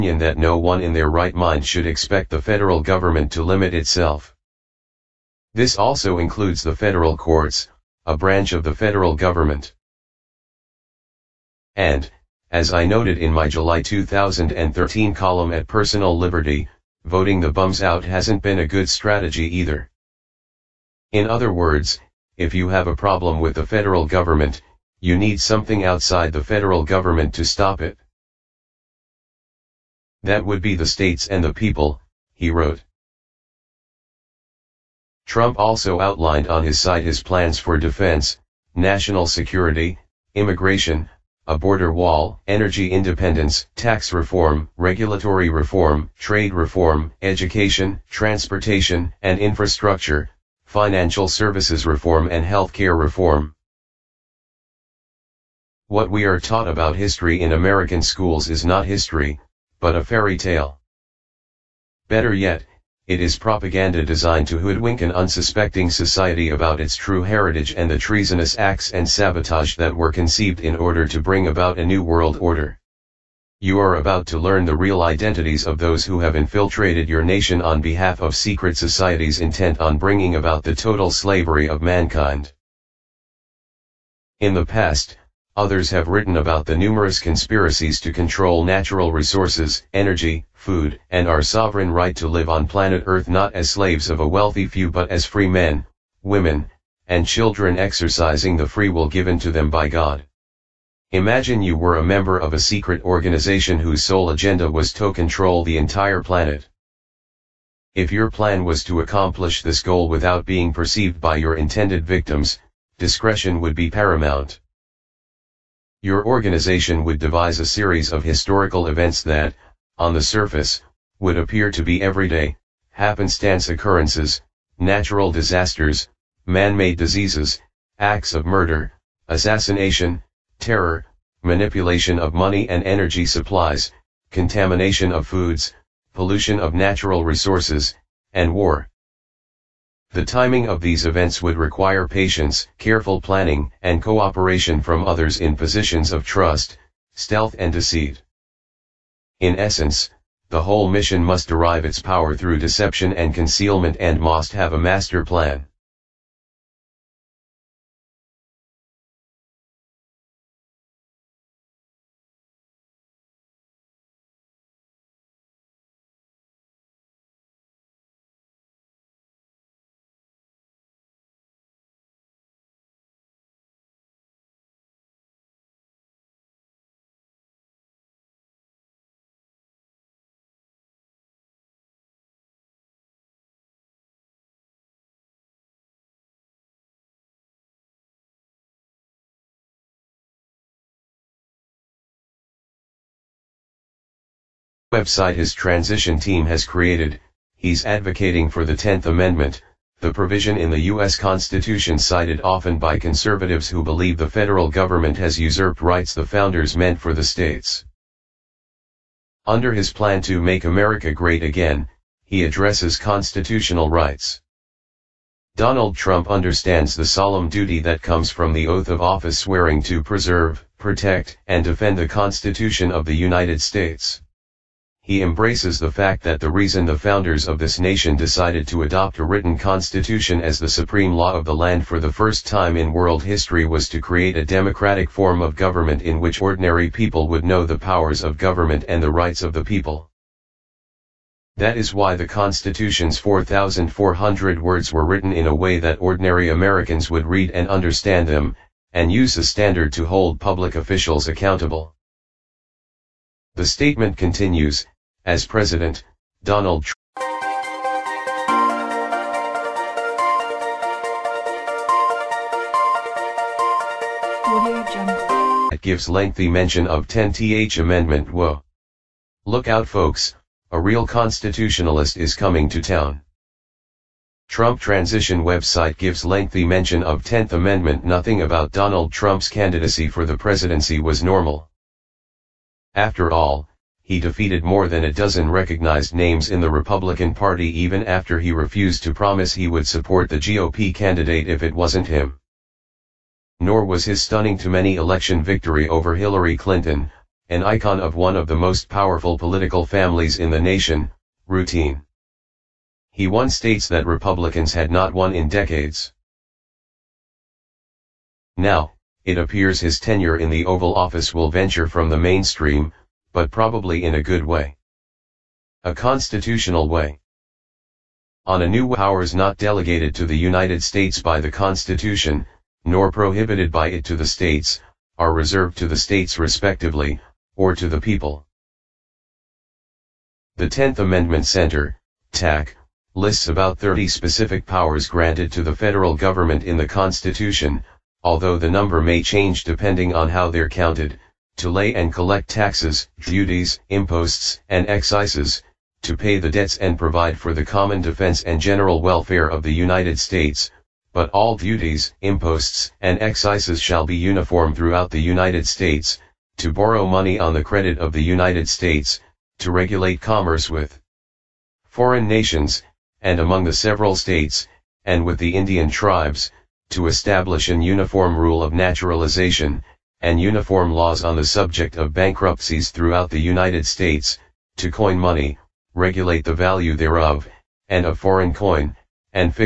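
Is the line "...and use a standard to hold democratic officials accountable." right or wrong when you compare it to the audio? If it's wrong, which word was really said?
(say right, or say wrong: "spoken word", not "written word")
wrong: "public", not "democratic".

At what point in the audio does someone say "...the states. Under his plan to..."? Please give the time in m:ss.
3:27.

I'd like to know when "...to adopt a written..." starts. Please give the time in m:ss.
3:48.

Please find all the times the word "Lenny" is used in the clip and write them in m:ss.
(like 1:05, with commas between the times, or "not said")
not said.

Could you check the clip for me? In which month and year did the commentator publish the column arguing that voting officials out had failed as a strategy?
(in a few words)
July 2013.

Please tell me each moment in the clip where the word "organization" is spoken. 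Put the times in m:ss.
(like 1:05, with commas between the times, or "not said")
1:43, 1:56.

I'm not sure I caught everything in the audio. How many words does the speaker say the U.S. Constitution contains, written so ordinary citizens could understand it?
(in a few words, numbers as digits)
4,400.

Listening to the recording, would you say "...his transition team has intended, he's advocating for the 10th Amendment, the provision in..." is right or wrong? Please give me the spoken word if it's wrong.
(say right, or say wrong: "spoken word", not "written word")
wrong: "created", not "intended".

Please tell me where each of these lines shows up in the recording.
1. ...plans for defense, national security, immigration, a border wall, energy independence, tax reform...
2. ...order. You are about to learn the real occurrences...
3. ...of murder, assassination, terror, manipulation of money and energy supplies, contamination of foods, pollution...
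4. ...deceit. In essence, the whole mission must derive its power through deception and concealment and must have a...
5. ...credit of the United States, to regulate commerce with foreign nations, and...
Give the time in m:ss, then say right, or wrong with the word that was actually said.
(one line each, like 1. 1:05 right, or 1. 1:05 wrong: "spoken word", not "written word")
1. 0:37 right
2. 1:12 wrong: "identities", not "occurrences"
3. 2:08 right
4. 2:27 right
5. 5:57 right.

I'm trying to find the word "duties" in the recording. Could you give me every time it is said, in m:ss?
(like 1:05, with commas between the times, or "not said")
5:43, 5:51.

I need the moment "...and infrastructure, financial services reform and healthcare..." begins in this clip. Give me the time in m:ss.
0:49.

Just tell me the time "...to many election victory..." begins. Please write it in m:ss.
4:54.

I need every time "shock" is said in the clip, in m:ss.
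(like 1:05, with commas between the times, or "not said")
not said.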